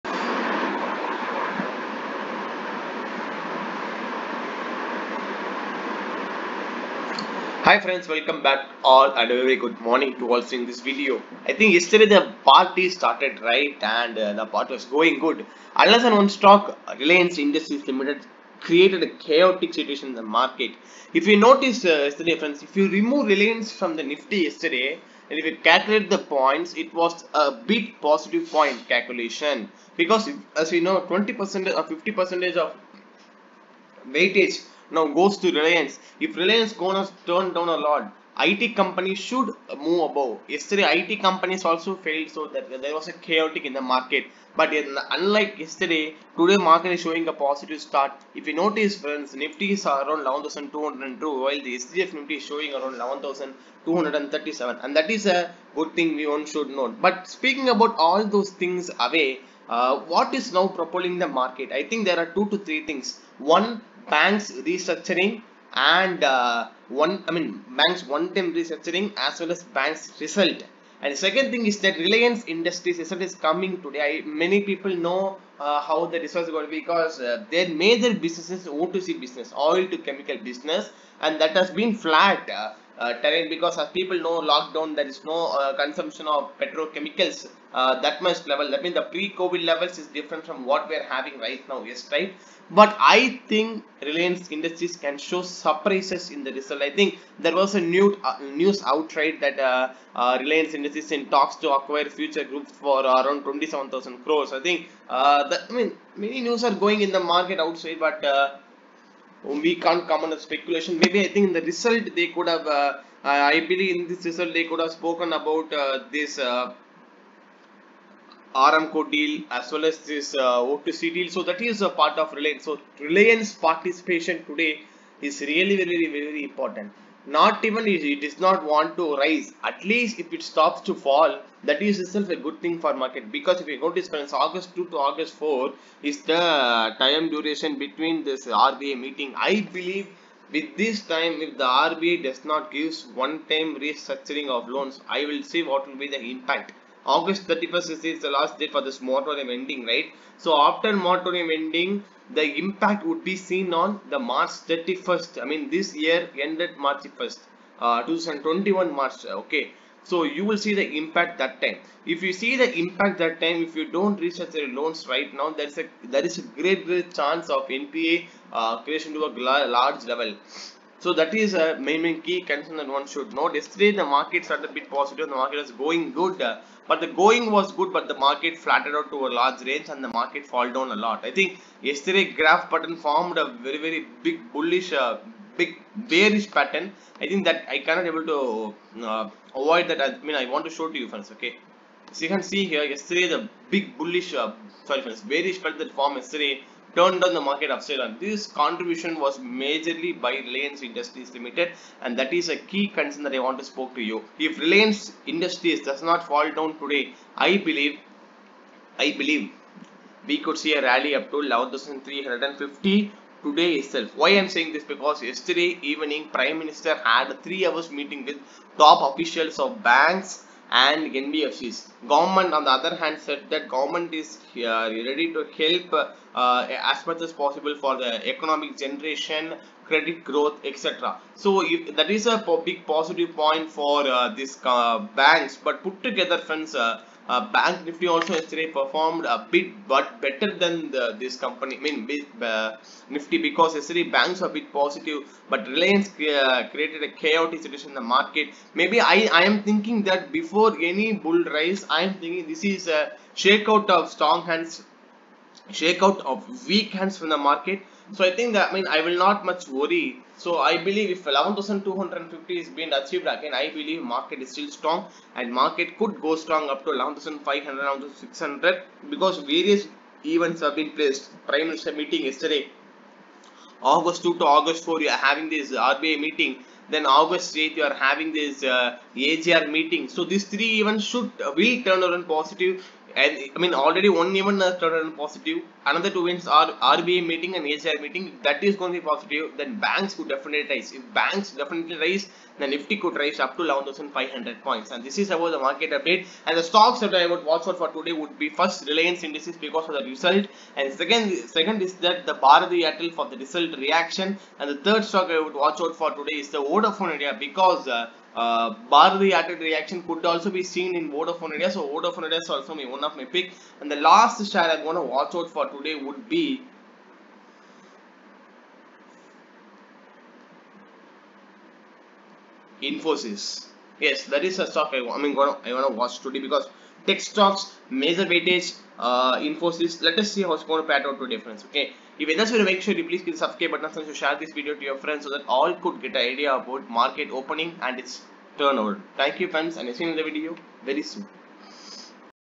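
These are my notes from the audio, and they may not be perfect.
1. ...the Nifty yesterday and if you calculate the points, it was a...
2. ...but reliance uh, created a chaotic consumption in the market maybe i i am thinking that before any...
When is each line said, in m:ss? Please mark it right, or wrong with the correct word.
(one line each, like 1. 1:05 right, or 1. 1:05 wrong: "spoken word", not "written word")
1. 0:23 right
2. 4:05 wrong: "situation", not "consumption".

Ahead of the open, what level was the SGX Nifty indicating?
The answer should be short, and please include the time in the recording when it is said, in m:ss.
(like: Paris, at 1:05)
11,237, at 0:52.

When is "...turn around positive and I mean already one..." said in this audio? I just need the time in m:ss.
4:41.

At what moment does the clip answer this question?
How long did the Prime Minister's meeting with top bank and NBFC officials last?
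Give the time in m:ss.
3:37.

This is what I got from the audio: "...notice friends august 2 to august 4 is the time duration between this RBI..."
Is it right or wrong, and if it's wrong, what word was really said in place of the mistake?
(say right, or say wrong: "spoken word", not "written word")
right.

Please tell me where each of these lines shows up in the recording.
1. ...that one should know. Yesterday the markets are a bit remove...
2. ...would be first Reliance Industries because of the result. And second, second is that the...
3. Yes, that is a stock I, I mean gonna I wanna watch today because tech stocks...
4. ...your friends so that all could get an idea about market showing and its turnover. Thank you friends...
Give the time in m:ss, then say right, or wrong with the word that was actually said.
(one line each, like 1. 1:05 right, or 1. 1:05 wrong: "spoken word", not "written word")
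1. 2:52 wrong: "positive", not "remove"
2. 4:58 right
3. 5:23 right
4. 5:34 wrong: "opening", not "showing".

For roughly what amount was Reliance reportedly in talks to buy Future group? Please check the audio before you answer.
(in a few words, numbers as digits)
27,000 crores.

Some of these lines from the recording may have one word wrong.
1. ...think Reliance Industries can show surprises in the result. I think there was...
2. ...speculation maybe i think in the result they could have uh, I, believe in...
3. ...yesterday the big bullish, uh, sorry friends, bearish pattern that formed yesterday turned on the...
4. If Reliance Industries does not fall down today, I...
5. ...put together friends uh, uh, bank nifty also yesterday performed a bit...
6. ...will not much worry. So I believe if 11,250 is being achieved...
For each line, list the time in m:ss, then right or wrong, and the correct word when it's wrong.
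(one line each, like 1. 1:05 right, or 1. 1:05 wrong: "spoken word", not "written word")
1. 1:33 right
2. 1:50 right
3. 3:12 right
4. 3:24 right
5. 3:55 right
6. 4:19 right.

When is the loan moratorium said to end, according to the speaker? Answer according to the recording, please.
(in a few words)
August 31st.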